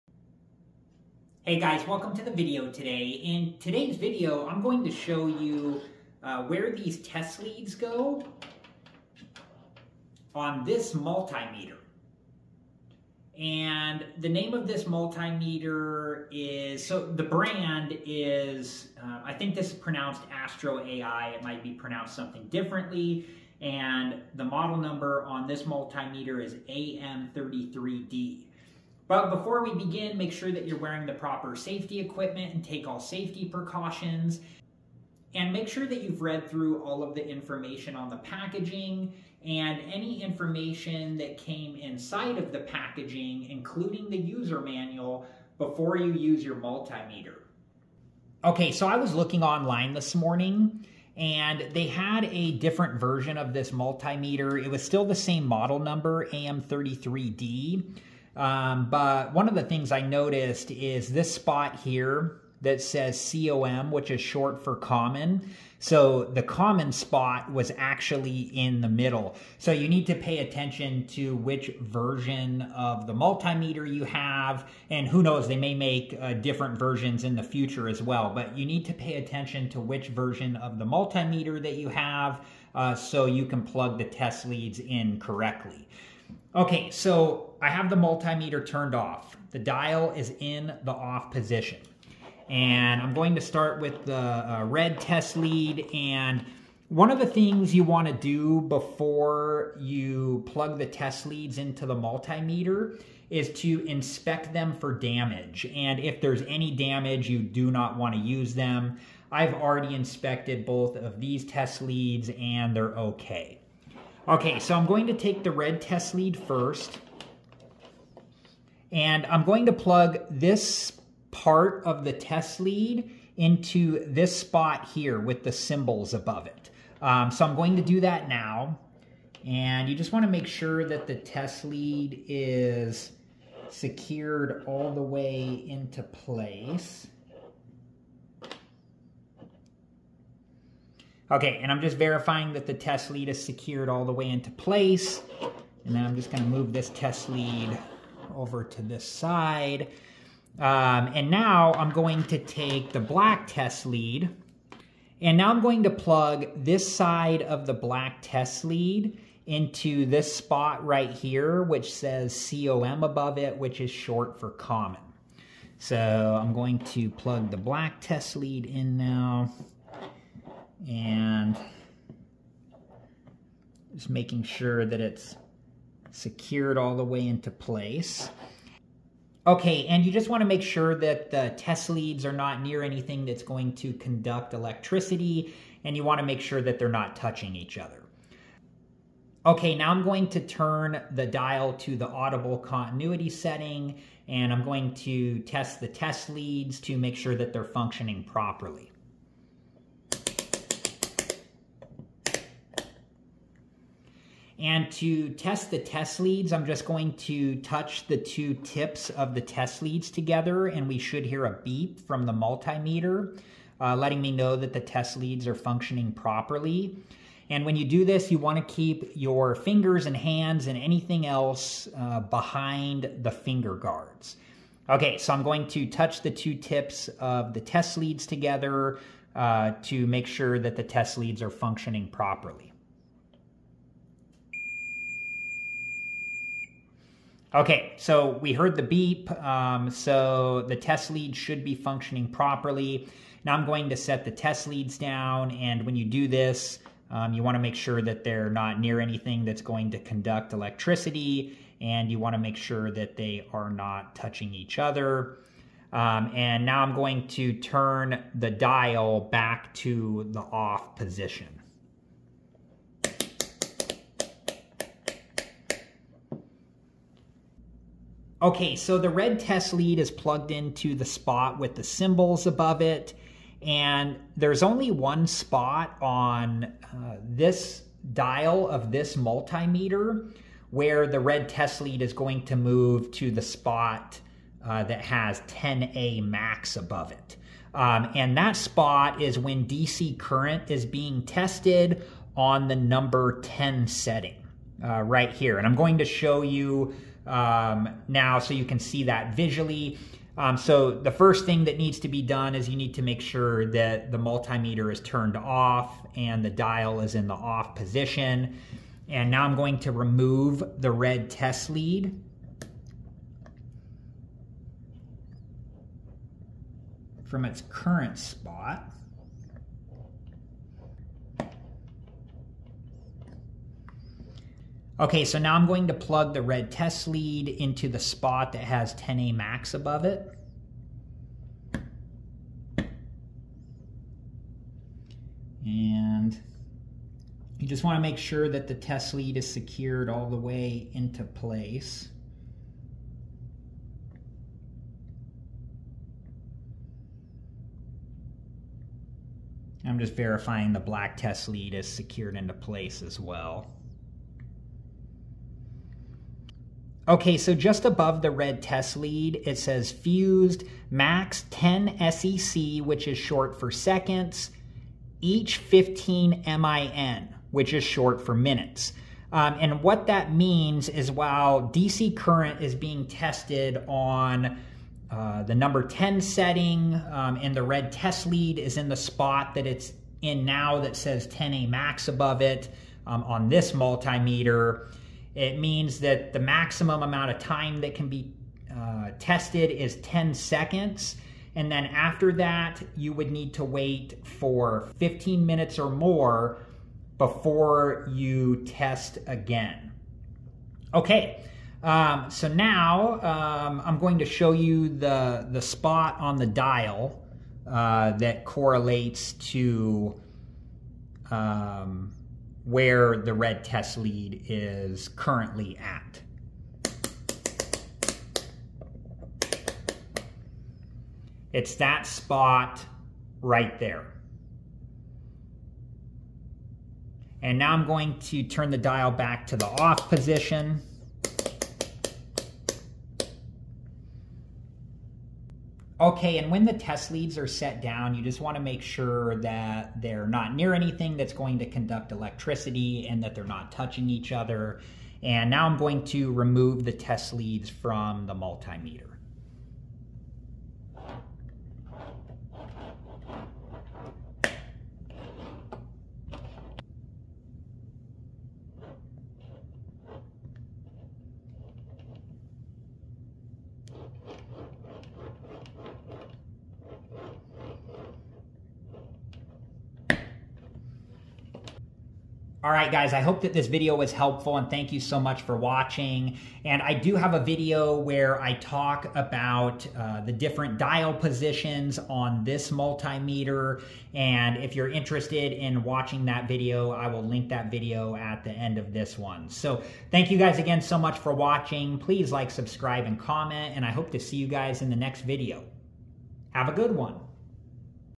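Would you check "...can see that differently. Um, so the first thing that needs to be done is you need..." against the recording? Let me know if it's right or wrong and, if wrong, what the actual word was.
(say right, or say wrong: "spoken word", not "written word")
wrong: "visually", not "differently".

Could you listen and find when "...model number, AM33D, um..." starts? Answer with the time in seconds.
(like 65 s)
55 s.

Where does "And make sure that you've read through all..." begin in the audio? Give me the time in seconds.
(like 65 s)
35 s.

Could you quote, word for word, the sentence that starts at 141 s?
Okay, and I'm just verifying that the test lead is secured all the way into place.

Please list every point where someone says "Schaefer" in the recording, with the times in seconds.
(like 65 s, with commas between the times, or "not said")
not said.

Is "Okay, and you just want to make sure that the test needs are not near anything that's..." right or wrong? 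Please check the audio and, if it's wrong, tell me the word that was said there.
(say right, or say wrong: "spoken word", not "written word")
wrong: "leads", not "needs".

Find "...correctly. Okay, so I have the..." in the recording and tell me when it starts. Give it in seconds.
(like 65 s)
85 s.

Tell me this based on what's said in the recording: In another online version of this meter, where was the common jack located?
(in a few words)
in the middle.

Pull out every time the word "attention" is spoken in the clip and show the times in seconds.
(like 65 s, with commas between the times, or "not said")
70 s, 79 s.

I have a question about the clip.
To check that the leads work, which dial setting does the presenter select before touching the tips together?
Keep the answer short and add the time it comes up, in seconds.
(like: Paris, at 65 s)
audible continuity, at 192 s.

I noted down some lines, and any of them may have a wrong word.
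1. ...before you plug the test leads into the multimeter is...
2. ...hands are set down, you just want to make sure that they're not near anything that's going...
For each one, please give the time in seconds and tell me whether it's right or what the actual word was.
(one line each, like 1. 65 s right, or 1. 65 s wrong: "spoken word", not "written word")
1. 98 s right
2. 437 s wrong: "leads", not "hands".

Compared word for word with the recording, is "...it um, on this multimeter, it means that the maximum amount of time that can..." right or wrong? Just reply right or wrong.
right.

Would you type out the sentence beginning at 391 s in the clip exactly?
And then after that, you would need to wait for 15 minutes or more before you test again.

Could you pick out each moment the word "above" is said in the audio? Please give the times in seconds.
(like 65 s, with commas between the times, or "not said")
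126 s, 163 s, 272 s, 286 s, 329 s, 357 s, 382 s.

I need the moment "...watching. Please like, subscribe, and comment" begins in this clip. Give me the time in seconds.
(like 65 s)
491 s.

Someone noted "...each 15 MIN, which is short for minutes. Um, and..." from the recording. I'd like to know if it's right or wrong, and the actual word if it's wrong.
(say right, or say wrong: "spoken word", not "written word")
right.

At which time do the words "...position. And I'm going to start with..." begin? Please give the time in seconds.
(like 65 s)
91 s.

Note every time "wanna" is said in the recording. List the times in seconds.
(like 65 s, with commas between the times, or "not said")
97 s, 107 s.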